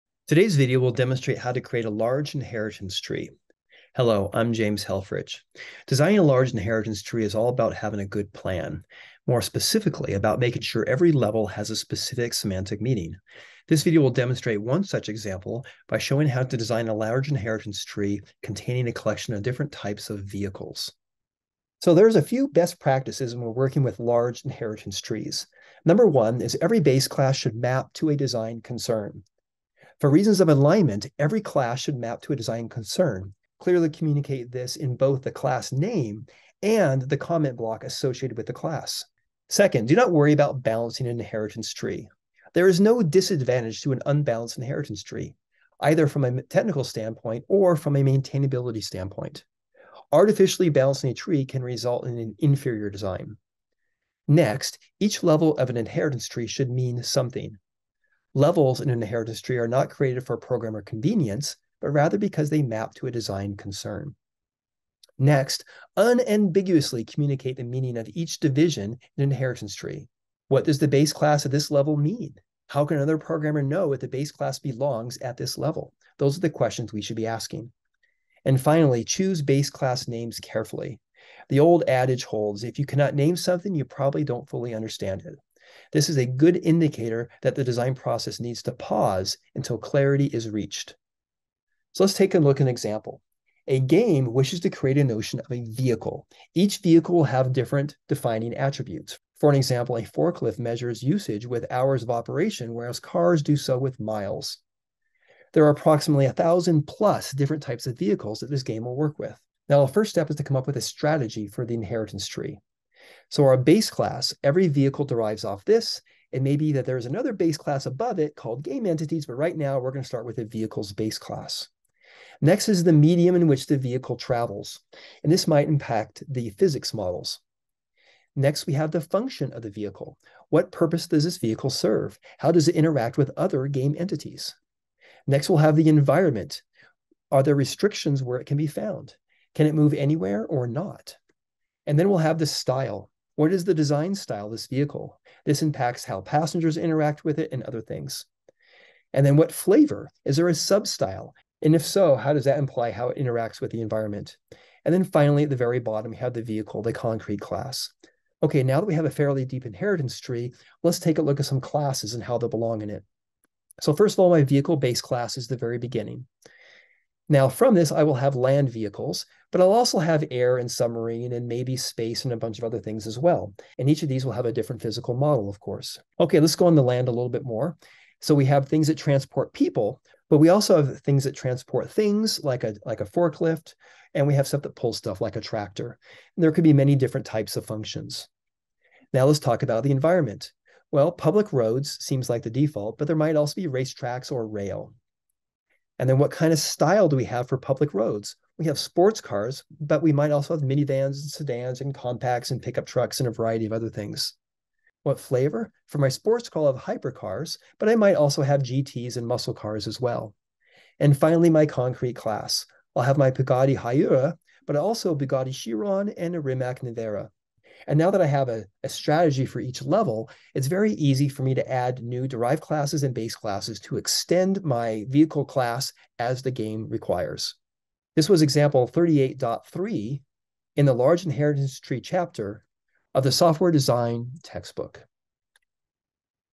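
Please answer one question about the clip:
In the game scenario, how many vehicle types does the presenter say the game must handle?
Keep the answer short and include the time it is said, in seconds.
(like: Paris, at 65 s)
1,000+, at 106 s.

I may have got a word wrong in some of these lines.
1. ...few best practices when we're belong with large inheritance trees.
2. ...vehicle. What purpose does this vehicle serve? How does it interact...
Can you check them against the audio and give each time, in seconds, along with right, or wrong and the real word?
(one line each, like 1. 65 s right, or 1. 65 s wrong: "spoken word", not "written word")
1. 22 s wrong: "working", not "belong"
2. 129 s right.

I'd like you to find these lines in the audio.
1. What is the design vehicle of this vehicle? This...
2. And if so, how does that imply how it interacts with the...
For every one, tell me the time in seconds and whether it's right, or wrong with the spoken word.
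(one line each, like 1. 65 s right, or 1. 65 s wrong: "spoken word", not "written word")
1. 143 s wrong: "style", not "vehicle"
2. 151 s right.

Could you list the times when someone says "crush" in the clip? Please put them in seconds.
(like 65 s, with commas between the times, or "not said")
not said.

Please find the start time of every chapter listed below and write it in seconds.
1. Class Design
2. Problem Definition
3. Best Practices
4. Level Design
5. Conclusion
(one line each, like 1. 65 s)
1. 160 s
2. 91 s
3. 21 s
4. 109 s
5. 227 s.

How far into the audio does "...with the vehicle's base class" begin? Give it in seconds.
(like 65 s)
120 s.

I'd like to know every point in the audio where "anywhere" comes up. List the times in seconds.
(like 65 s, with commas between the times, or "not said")
139 s.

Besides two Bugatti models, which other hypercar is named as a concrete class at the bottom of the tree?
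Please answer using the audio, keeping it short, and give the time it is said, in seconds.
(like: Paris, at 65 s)
Rimac Nevera, at 216 s.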